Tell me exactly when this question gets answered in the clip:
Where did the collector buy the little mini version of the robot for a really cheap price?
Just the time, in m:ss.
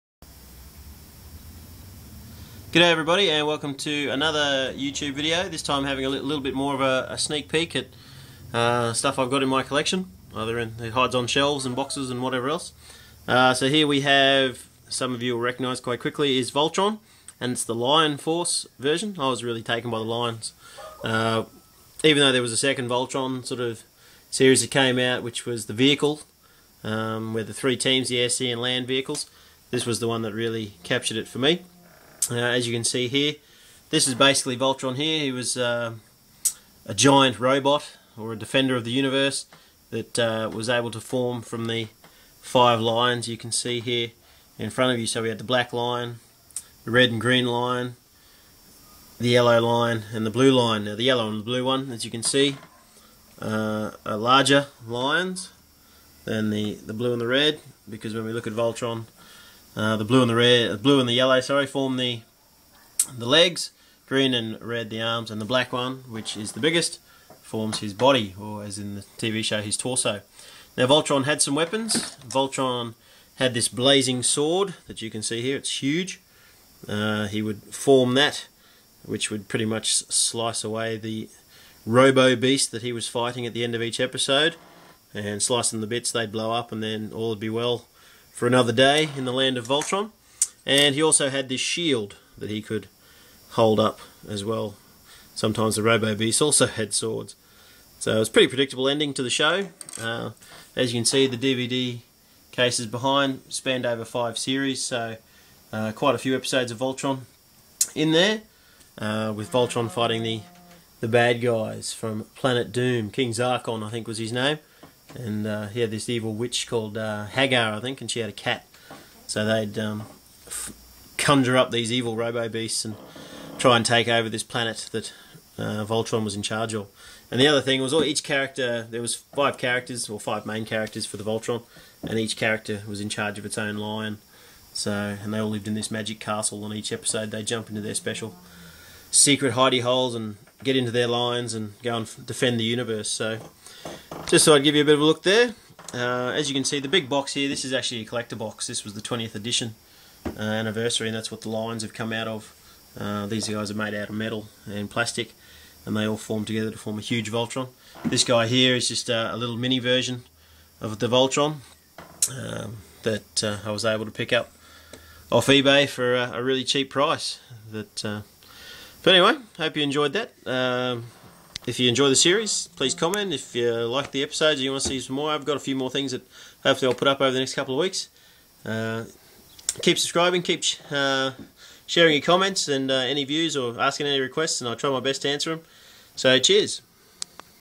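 2:45.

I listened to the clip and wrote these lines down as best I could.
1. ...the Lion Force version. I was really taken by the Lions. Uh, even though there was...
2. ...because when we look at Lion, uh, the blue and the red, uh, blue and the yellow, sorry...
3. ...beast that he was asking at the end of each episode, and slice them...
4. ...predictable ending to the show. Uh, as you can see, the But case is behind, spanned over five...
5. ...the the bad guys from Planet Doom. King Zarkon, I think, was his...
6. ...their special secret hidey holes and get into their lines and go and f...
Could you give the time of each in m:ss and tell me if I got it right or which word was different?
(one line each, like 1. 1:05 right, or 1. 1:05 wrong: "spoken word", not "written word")
1. 0:17 right
2. 0:57 wrong: "Voltron", not "Lion"
3. 1:22 wrong: "fighting", not "asking"
4. 1:38 wrong: "DVD", not "But"
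5. 1:50 right
6. 2:17 right.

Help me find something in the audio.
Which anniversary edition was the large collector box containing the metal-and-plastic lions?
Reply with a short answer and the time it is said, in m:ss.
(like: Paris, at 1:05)
20th, at 2:29.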